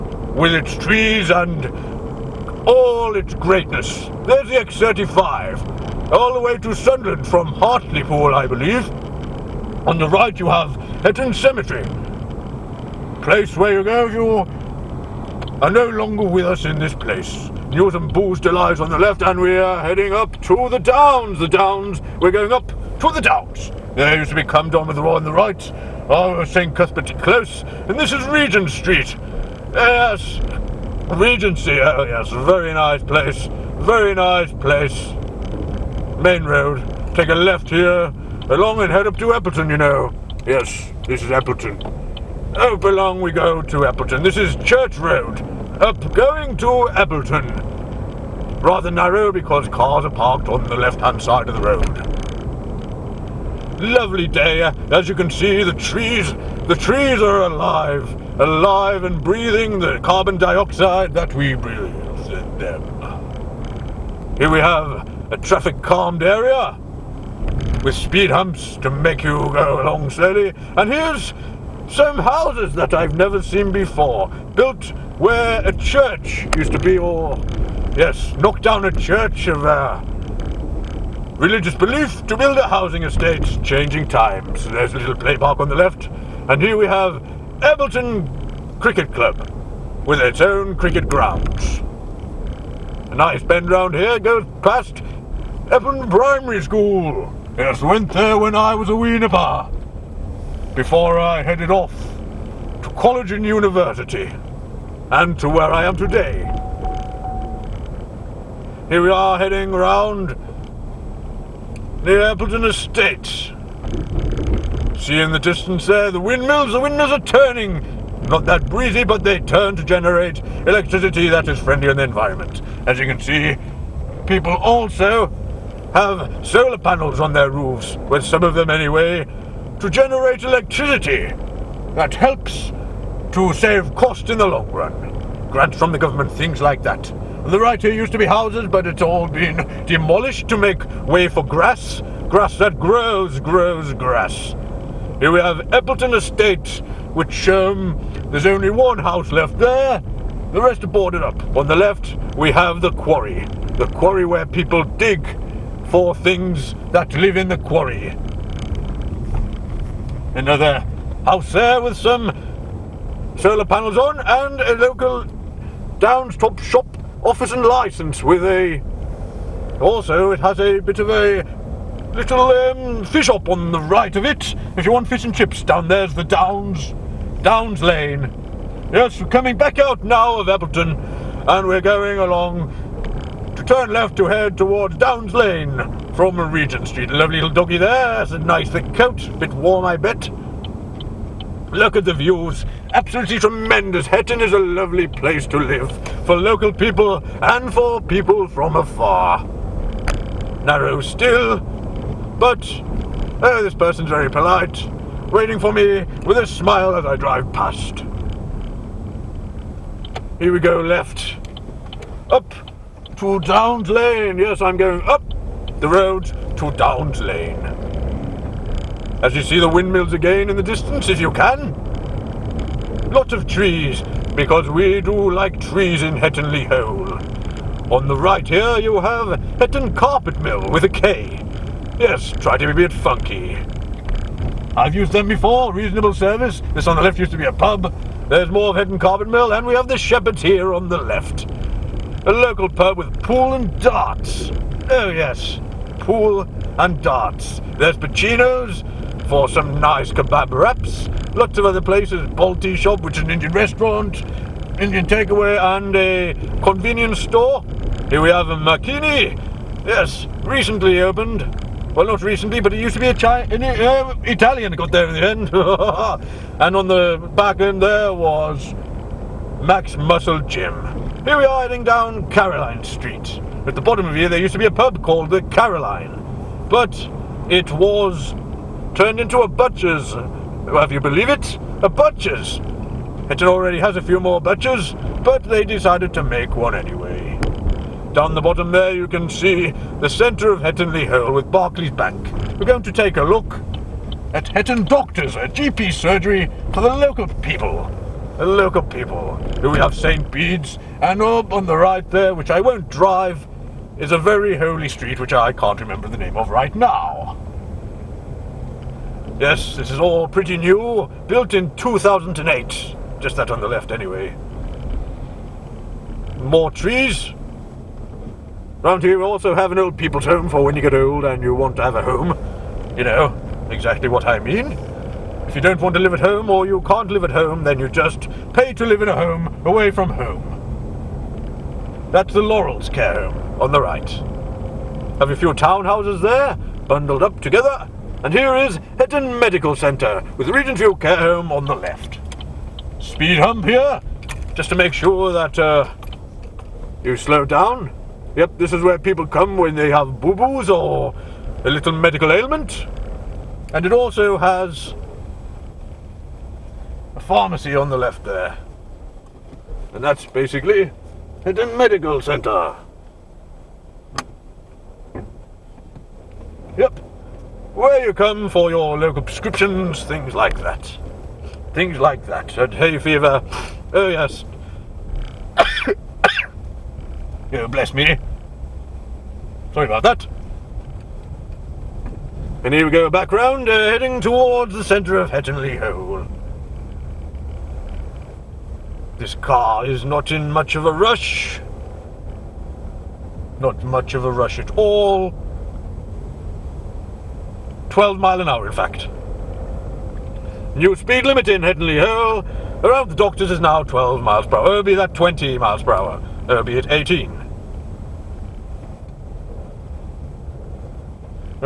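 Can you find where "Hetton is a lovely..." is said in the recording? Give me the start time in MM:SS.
03:14.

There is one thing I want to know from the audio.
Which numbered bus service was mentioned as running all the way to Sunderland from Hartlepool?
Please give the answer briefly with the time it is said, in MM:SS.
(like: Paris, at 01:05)
X35, at 00:04.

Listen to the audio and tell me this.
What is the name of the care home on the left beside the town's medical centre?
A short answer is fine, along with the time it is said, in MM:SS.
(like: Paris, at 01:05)
Regent View Care Home, at 05:40.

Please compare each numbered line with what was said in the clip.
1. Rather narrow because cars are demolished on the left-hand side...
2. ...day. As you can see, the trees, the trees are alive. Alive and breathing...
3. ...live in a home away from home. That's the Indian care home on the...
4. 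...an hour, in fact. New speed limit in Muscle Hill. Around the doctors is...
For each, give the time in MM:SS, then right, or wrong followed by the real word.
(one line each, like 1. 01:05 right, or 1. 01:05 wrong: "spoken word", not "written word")
1. 00:48 wrong: "parked", not "demolished"
2. 00:54 right
3. 05:28 wrong: "Laurels", not "Indian"
4. 06:38 wrong: "Headley", not "Muscle".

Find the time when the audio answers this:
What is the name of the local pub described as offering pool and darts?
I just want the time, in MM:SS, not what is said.
03:59.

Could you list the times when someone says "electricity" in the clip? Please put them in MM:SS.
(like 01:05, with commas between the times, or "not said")
02:00, 02:10.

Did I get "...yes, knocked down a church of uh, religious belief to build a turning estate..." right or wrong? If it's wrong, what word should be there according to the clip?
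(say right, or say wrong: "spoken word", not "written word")
wrong: "housing", not "turning".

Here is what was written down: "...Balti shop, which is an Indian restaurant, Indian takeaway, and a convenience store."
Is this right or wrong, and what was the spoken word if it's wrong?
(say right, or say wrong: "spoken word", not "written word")
right.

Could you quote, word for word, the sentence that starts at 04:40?
Well, if you believe it, a butcher's.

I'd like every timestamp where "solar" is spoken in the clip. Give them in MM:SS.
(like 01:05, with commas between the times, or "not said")
02:06, 02:43.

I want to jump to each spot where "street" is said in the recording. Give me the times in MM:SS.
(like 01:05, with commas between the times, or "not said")
00:28, 03:06, 04:32, 05:04.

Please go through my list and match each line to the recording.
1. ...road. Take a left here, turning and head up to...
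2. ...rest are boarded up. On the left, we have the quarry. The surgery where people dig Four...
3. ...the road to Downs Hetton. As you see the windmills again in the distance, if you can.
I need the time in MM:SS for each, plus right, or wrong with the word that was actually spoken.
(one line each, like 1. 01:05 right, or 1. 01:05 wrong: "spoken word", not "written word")
1. 00:36 wrong: "along", not "turning"
2. 02:30 wrong: "quarry", not "surgery"
3. 03:35 wrong: "Lane", not "Hetton".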